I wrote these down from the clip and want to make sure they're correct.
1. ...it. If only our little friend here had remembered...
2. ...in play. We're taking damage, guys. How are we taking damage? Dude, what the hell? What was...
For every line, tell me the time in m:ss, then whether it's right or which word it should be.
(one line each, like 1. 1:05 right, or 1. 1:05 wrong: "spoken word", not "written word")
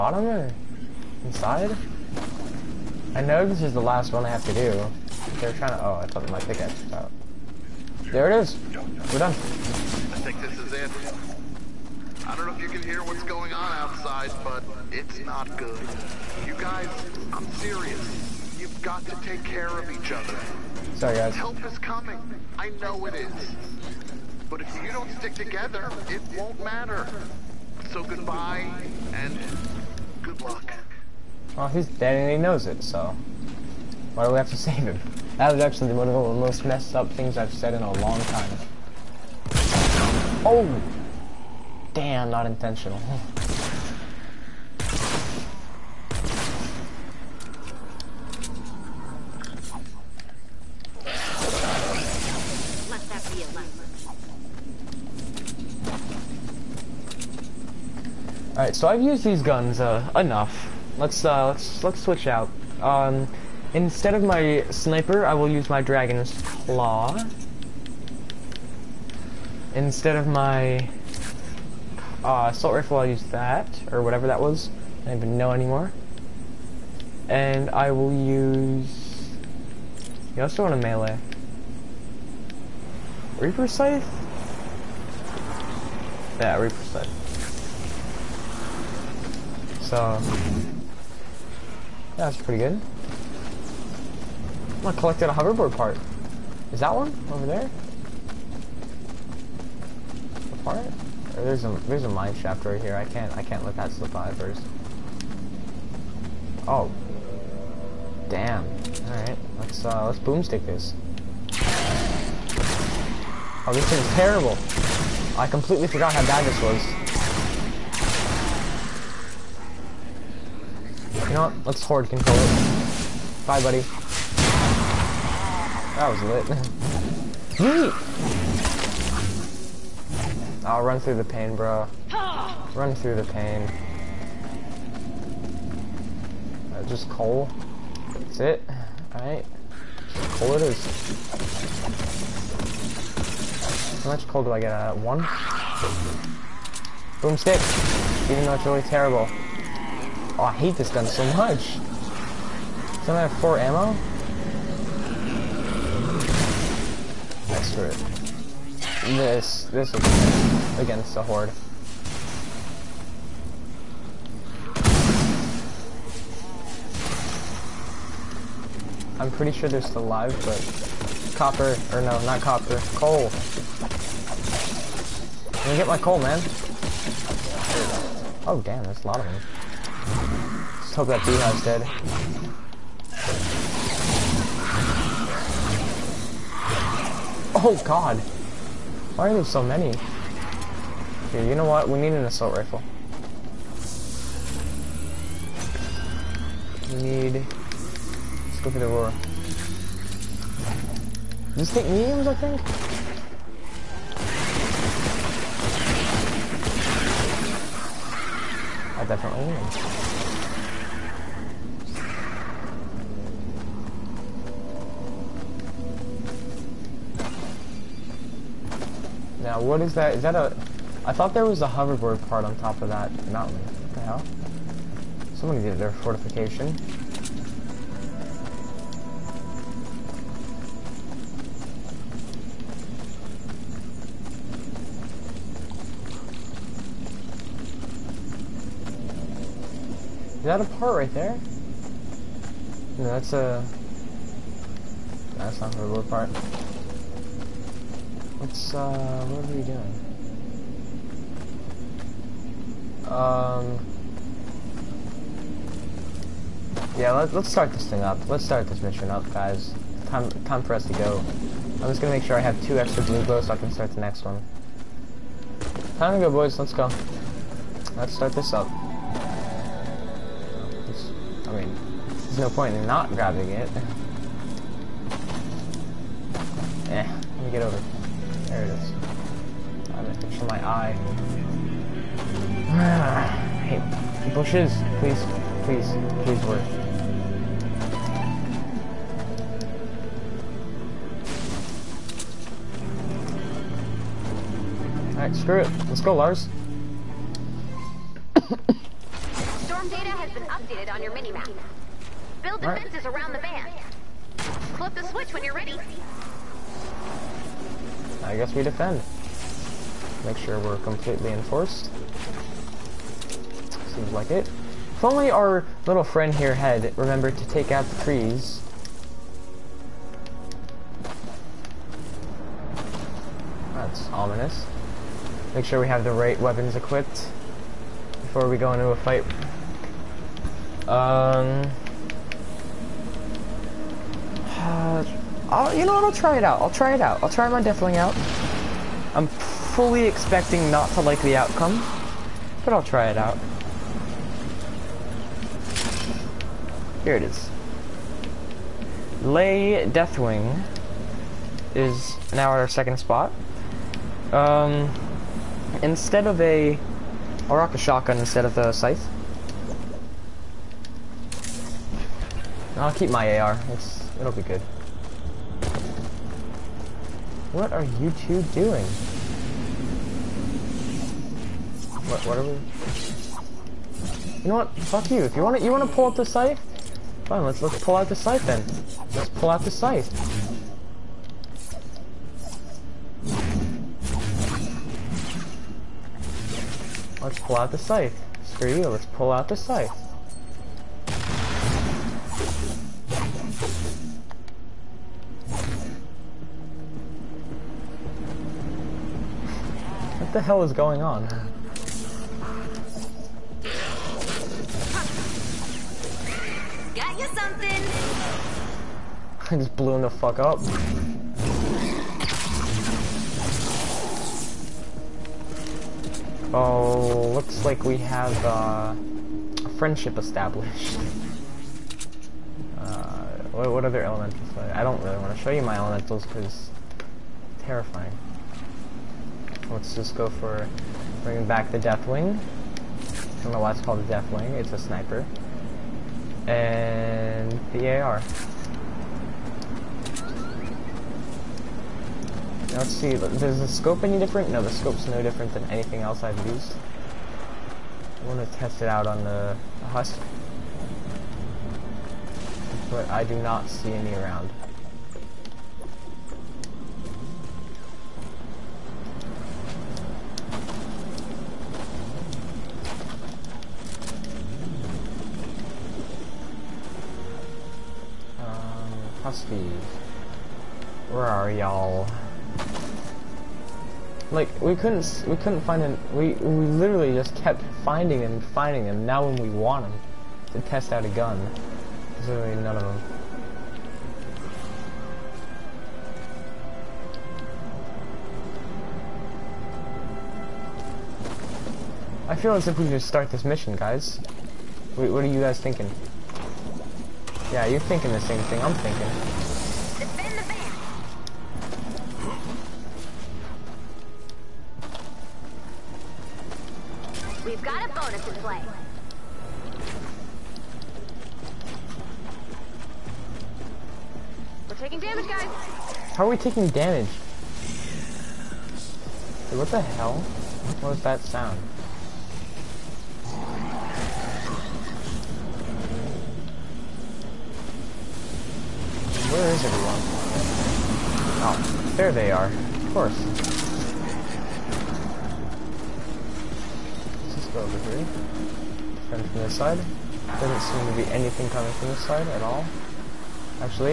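1. 5:14 right
2. 8:28 right.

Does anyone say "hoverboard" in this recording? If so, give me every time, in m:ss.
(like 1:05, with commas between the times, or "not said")
1:35, 3:41, 4:05.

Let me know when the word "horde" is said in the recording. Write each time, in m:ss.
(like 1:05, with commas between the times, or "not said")
2:01, 2:41.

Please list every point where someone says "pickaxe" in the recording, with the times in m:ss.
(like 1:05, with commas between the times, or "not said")
0:06.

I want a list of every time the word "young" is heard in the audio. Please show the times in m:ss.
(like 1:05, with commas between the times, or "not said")
not said.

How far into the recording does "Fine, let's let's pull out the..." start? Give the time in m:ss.
6:17.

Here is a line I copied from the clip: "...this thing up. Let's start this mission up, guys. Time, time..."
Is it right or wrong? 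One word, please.
right.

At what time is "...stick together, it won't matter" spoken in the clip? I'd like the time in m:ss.
0:25.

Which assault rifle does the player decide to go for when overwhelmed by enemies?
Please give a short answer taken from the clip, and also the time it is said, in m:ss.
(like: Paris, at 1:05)
Aurora, at 3:18.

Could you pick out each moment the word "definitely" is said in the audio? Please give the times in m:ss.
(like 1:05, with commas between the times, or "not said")
3:29.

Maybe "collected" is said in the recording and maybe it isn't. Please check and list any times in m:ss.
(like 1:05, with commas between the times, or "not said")
1:34.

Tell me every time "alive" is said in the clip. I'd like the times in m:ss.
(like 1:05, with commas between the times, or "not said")
2:50.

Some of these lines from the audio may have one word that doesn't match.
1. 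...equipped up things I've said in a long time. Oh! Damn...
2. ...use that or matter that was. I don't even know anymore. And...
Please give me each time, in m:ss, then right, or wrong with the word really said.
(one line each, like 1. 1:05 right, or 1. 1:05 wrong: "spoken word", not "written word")
1. 0:36 wrong: "messed", not "equipped"
2. 1:13 wrong: "whatever", not "matter".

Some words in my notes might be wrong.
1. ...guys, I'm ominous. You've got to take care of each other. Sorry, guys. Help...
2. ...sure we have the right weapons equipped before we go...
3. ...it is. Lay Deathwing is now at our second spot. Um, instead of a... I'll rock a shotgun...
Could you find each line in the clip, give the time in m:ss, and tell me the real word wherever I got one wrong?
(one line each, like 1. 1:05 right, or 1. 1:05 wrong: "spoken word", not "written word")
1. 0:16 wrong: "serious", not "ominous"
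2. 5:25 right
3. 5:47 right.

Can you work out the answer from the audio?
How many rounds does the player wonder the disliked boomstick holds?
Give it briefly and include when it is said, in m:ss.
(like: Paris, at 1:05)
4, at 2:33.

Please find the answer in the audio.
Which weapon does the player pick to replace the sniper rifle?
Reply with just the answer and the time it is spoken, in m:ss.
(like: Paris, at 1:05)
Dragon's Claw, at 1:05.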